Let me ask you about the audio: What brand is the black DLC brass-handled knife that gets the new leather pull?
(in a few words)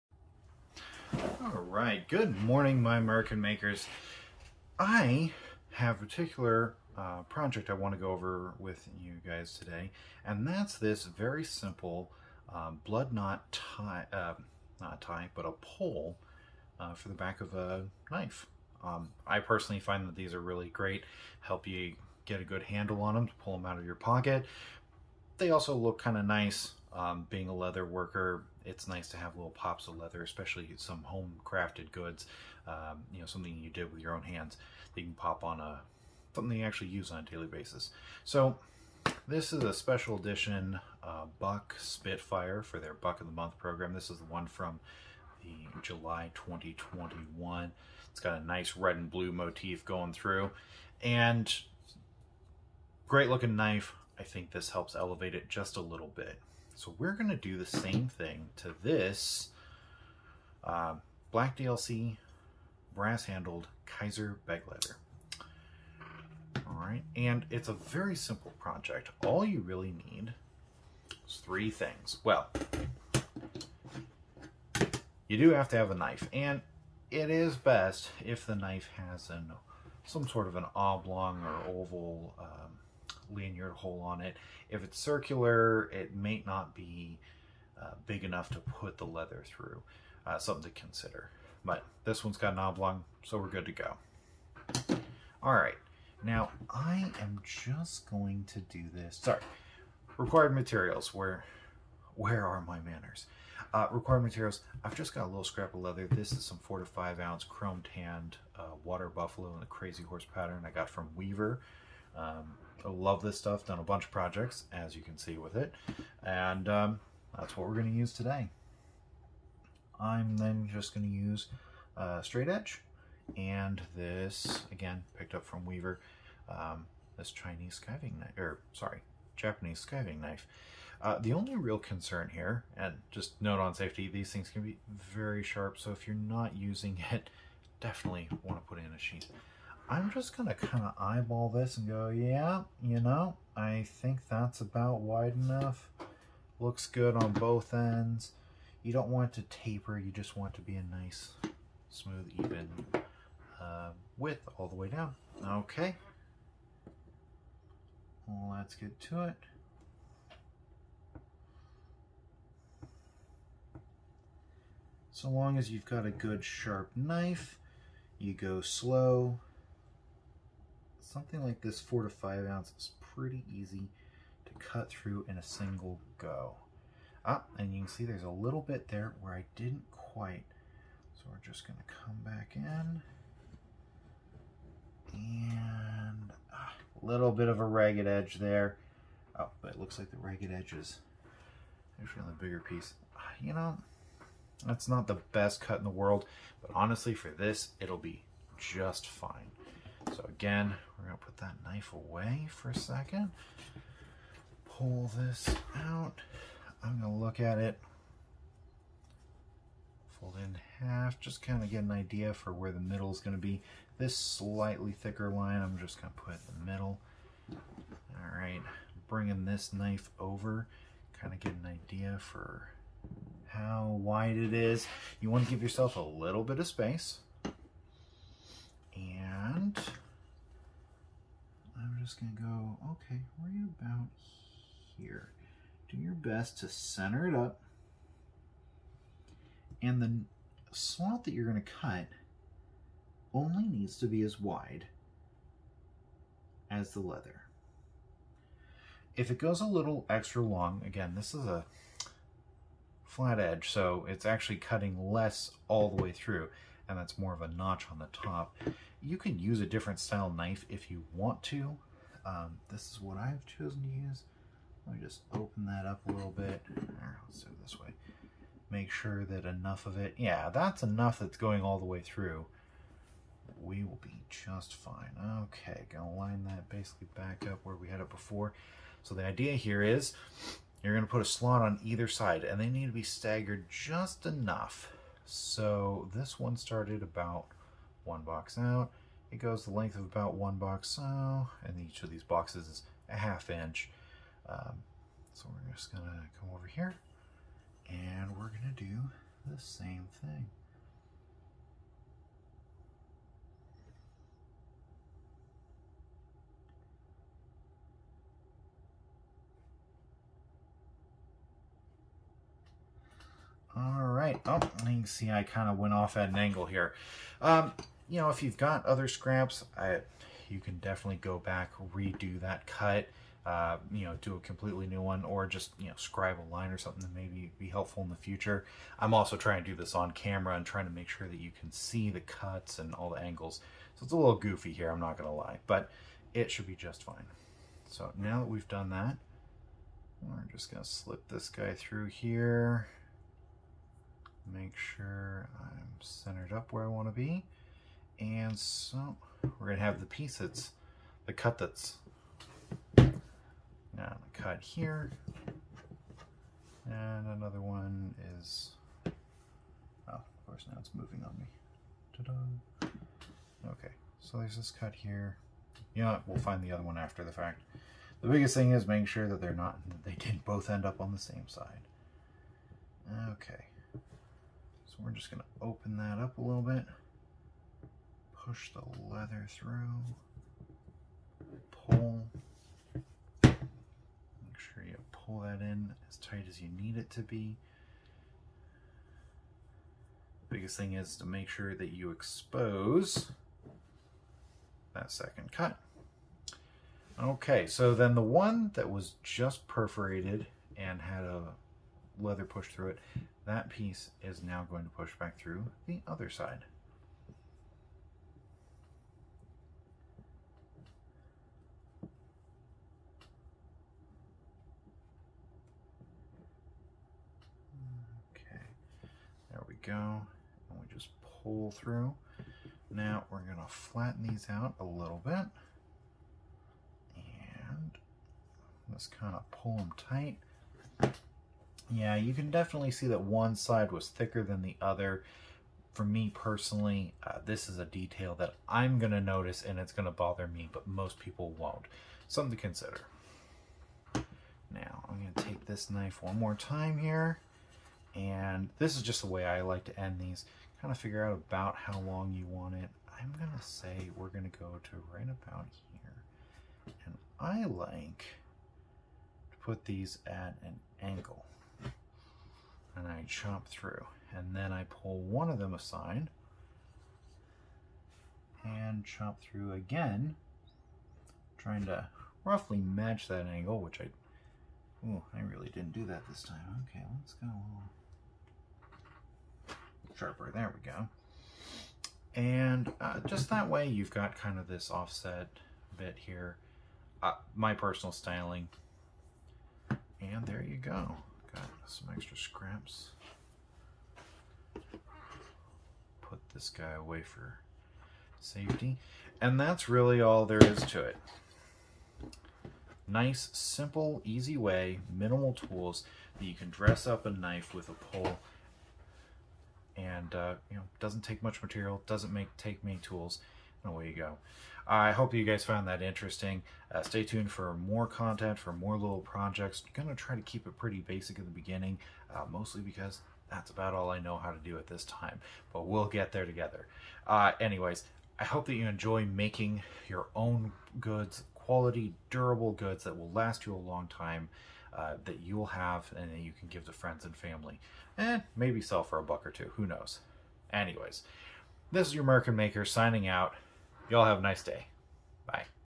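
Kizer.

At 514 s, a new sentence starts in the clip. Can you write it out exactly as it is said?
I hope you guys found that interesting.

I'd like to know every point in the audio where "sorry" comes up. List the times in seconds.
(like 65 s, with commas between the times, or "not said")
99 s, 128 s.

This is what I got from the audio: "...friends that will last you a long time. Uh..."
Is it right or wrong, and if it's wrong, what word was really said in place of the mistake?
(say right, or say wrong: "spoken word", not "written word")
wrong: "goods", not "friends".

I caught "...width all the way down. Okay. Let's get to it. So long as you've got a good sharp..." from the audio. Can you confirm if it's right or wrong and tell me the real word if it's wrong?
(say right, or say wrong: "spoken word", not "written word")
right.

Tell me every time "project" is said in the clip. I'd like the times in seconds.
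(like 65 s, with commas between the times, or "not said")
7 s, 68 s, 114 s, 519 s.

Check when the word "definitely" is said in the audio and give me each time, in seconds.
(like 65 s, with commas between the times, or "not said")
137 s, 320 s, 432 s.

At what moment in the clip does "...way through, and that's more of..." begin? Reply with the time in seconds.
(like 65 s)
256 s.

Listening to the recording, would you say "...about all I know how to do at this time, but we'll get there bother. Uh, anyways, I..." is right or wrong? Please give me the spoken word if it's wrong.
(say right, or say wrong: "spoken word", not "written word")
wrong: "together", not "bother".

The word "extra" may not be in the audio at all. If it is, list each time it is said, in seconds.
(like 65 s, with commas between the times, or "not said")
250 s, 492 s.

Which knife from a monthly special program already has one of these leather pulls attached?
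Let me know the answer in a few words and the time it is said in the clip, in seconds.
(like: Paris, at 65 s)
Buck Spitfire, at 41 s.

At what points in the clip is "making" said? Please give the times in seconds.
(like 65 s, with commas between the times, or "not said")
368 s, 529 s.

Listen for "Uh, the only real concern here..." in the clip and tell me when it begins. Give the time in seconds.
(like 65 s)
131 s.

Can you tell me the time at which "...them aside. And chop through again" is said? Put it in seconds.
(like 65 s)
465 s.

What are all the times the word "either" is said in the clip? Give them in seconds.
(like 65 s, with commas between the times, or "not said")
281 s.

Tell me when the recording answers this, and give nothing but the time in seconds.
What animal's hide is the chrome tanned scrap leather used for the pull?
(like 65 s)
108 s.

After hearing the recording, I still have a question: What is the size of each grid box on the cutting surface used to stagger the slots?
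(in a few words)
Half inch.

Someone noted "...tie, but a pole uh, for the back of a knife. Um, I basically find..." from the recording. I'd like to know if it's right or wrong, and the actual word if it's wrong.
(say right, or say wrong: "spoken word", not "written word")
wrong: "personally", not "basically".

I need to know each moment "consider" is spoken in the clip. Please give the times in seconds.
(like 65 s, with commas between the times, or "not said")
90 s, 442 s.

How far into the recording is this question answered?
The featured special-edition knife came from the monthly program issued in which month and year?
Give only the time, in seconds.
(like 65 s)
45 s.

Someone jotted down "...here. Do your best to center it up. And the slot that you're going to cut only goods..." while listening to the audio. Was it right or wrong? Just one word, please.
wrong.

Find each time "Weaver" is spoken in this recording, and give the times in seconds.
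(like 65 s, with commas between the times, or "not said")
111 s, 125 s.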